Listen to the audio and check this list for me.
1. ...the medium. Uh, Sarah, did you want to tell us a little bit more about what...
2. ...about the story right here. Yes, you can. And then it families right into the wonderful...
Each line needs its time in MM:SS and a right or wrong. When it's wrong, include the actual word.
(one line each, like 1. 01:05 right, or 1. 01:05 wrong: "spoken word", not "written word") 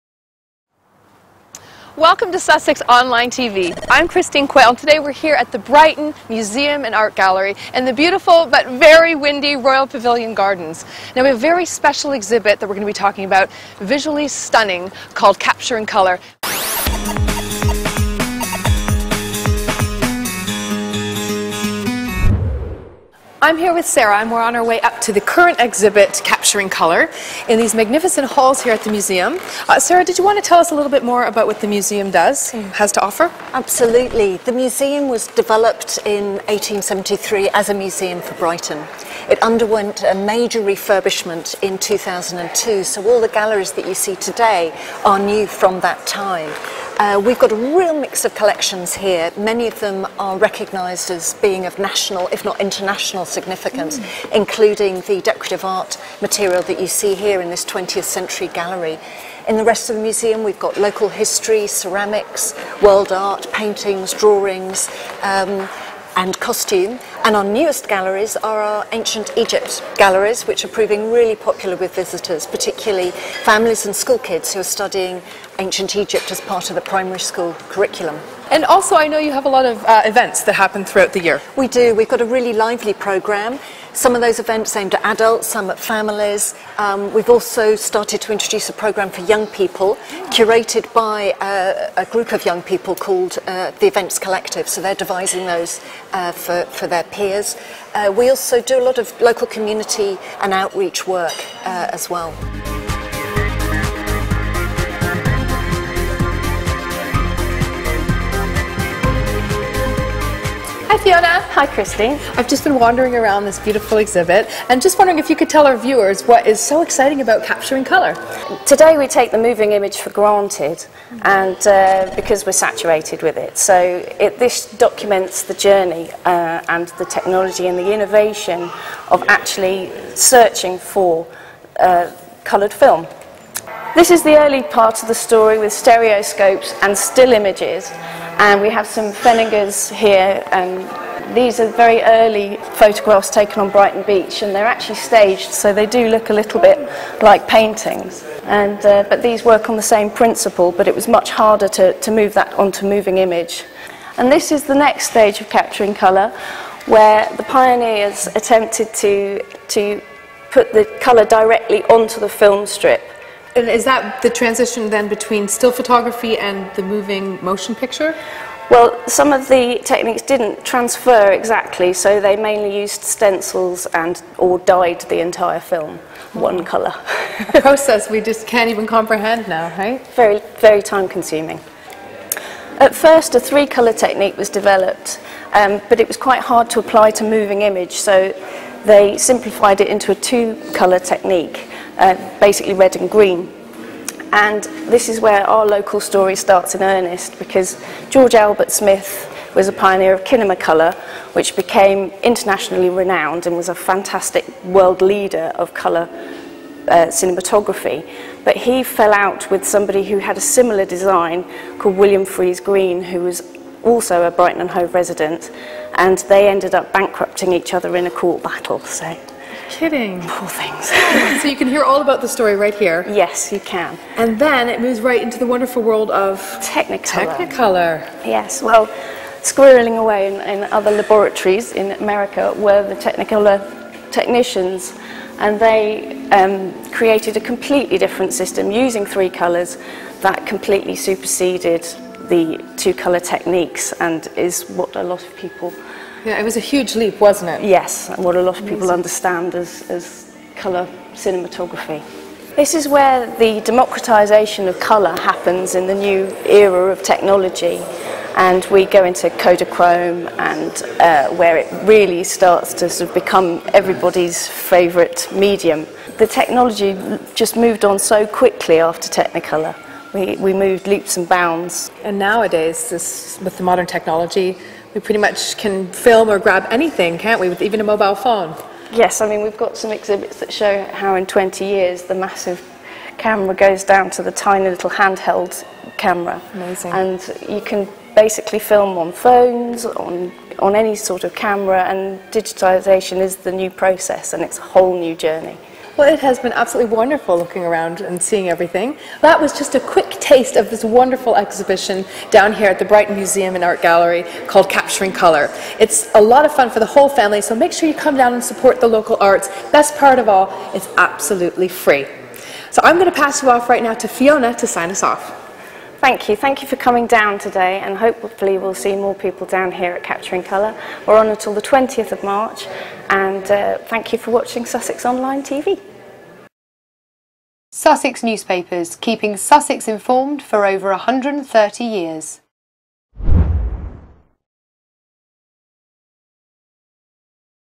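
1. 00:28 wrong: "museum", not "medium"
2. 03:42 wrong: "moves", not "families".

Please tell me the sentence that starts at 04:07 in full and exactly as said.
Yes, and what a lot of people understand as, as colour cinematography.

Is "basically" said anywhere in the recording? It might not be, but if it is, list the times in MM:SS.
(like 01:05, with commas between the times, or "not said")
03:12, 04:48.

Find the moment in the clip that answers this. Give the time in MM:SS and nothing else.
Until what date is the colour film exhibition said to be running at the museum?
05:21.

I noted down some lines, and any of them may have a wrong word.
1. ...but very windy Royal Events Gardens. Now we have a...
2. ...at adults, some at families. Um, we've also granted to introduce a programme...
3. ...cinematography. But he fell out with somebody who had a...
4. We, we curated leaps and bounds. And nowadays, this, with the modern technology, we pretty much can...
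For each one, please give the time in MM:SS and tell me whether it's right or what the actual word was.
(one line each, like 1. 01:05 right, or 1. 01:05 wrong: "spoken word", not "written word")
1. 00:08 wrong: "Pavilion", not "Events"
2. 01:24 wrong: "started", not "granted"
3. 03:27 right
4. 04:30 wrong: "moved", not "curated".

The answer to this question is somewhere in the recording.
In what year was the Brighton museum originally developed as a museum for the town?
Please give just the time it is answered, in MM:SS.
00:36.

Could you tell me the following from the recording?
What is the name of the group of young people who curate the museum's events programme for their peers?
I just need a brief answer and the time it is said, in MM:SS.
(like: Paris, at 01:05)
the Events Collective, at 01:33.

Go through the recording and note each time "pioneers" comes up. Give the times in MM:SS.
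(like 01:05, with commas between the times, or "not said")
02:37, 03:19.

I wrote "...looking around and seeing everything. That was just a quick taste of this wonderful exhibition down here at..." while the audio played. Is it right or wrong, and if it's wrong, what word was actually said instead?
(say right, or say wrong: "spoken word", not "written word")
right.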